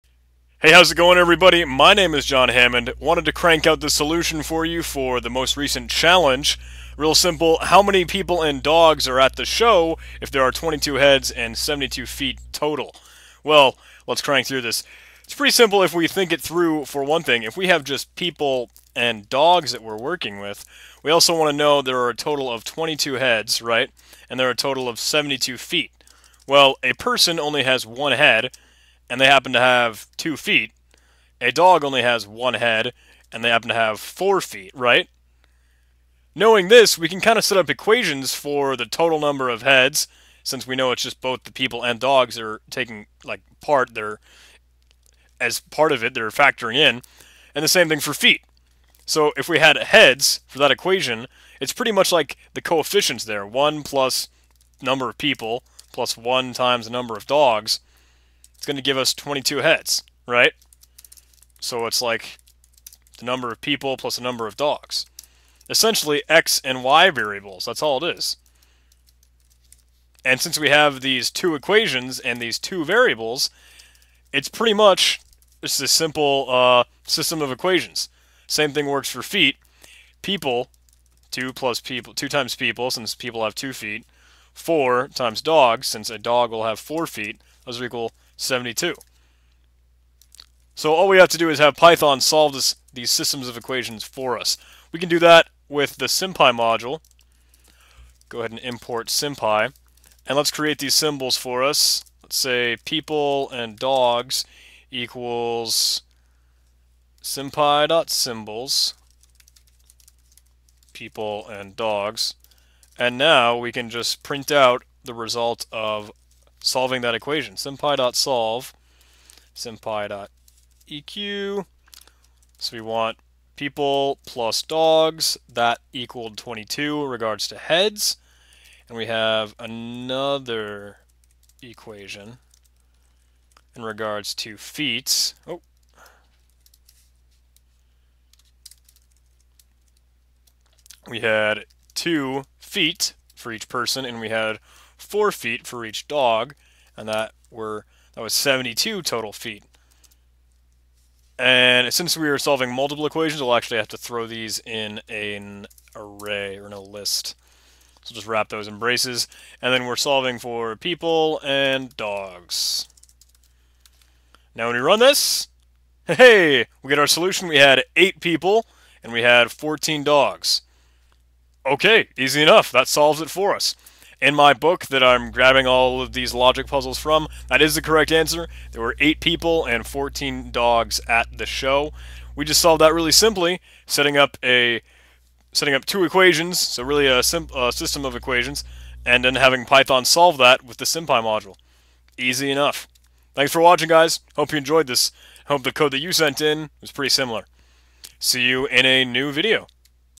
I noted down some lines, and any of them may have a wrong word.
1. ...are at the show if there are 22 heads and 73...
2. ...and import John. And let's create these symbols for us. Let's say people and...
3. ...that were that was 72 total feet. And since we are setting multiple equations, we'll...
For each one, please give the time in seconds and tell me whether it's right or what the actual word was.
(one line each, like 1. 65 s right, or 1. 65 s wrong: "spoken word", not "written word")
1. 9 s wrong: "72", not "73"
2. 98 s wrong: "SymPy", not "John"
3. 147 s wrong: "solving", not "setting".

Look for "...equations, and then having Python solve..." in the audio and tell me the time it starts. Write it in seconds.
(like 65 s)
188 s.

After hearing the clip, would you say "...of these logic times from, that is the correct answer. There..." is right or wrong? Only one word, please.
wrong.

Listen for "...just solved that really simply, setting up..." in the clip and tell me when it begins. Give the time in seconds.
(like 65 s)
182 s.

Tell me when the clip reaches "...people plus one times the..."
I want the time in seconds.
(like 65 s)
55 s.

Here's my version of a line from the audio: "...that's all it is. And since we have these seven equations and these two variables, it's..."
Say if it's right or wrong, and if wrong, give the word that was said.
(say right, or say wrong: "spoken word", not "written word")
wrong: "two", not "seven".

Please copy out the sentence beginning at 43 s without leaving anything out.
They're as part of it, they're factoring in, and the same thing for feet.